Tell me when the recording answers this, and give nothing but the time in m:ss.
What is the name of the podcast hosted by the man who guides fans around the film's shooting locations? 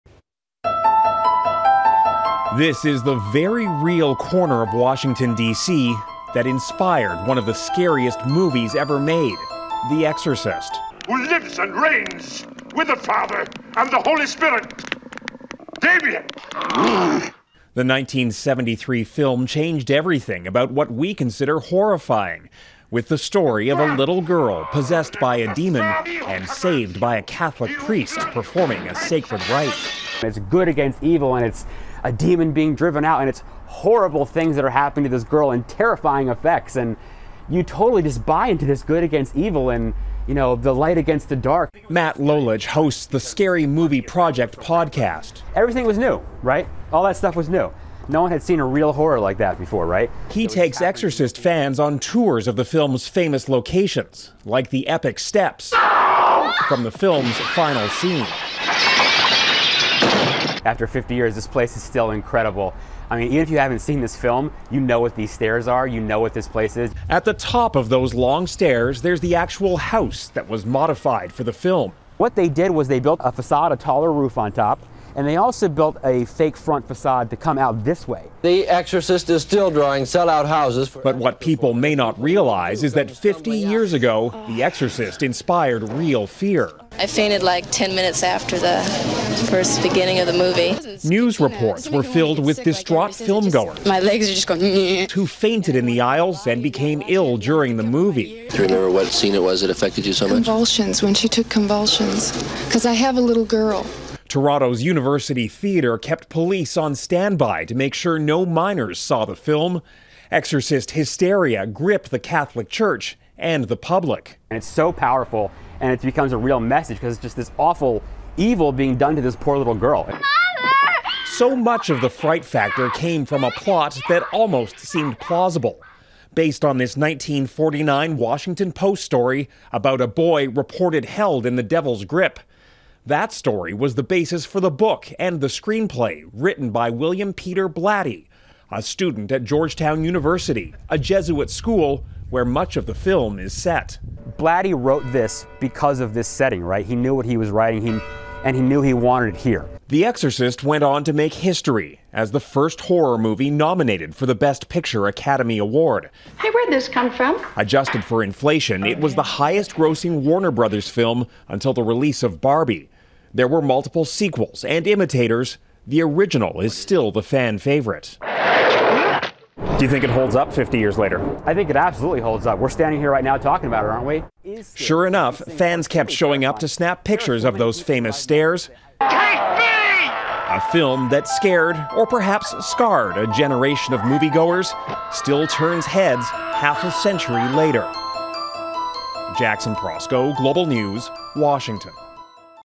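0:43.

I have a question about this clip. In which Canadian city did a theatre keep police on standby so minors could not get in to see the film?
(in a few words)
Toronto.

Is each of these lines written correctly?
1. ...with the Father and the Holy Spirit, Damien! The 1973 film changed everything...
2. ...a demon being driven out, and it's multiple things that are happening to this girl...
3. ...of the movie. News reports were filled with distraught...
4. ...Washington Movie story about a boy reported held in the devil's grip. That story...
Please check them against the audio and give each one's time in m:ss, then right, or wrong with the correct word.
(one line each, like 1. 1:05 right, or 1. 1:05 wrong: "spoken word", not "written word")
1. 0:12 right
2. 0:32 wrong: "horrible", not "multiple"
3. 1:30 right
4. 2:08 wrong: "Post", not "Movie".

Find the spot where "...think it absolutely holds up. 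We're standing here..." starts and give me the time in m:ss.
2:51.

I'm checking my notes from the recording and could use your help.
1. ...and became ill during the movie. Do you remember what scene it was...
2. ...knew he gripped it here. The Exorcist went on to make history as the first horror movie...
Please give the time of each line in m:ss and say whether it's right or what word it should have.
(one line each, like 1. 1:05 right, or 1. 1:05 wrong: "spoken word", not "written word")
1. 1:36 right
2. 2:28 wrong: "wanted", not "gripped".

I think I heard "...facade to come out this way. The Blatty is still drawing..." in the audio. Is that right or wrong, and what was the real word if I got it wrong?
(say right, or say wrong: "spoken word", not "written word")
wrong: "Exorcist", not "Blatty".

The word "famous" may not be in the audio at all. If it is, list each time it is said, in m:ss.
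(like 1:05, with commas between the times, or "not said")
0:53, 2:57.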